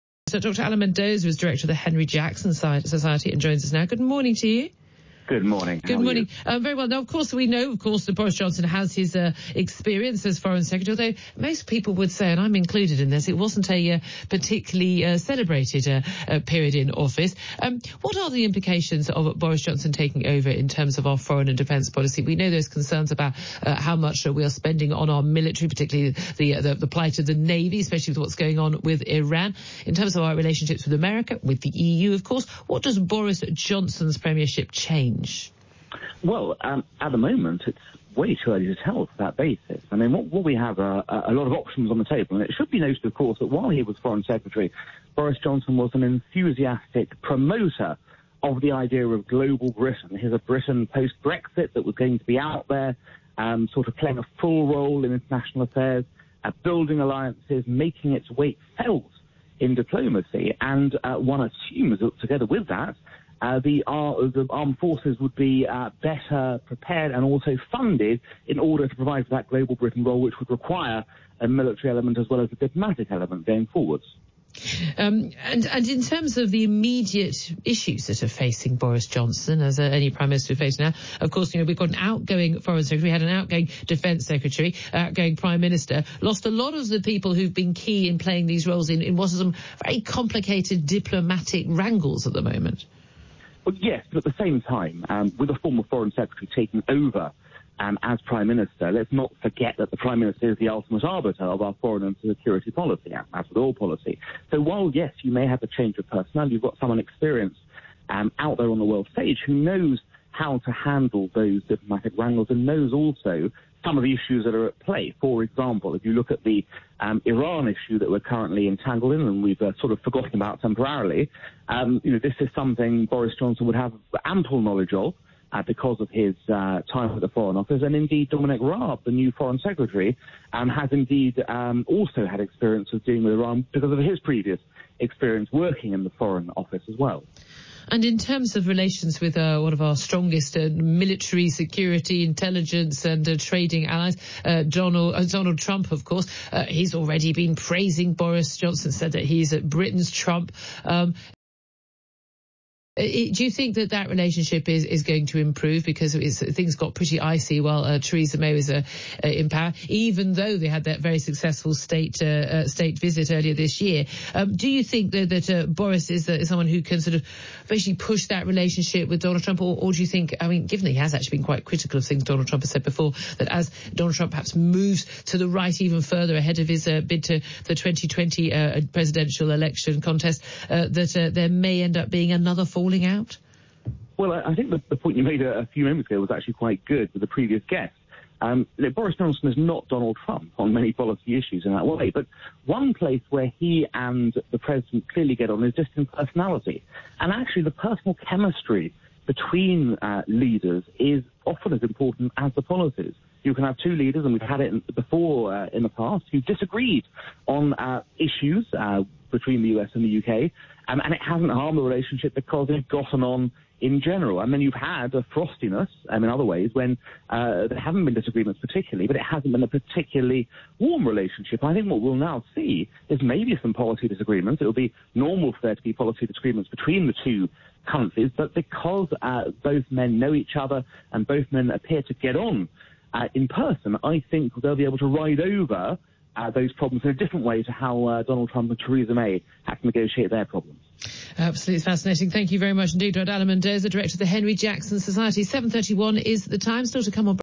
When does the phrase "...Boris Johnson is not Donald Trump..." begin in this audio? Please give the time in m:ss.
3:08.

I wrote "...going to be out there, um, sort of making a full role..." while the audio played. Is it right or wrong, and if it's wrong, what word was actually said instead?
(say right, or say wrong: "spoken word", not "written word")
wrong: "playing", not "making".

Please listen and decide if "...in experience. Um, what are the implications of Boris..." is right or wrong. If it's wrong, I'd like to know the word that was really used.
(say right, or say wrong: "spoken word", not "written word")
wrong: "office", not "experience".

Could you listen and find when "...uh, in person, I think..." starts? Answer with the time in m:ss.
3:53.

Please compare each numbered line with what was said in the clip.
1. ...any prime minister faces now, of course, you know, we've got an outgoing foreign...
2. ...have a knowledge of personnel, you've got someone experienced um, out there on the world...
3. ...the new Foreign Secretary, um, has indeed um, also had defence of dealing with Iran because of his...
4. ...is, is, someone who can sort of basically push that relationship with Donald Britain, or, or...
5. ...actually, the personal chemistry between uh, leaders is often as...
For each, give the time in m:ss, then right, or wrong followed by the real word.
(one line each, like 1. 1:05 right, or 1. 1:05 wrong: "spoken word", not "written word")
1. 1:19 right
2. 1:45 wrong: "change", not "knowledge"
3. 2:09 wrong: "experience", not "defence"
4. 2:46 wrong: "Trump", not "Britain"
5. 3:17 right.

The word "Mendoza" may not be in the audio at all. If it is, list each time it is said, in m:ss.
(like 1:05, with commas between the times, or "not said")
0:00, 4:03.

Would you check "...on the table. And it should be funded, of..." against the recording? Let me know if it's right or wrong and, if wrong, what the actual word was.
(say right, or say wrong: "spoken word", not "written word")
wrong: "noted", not "funded".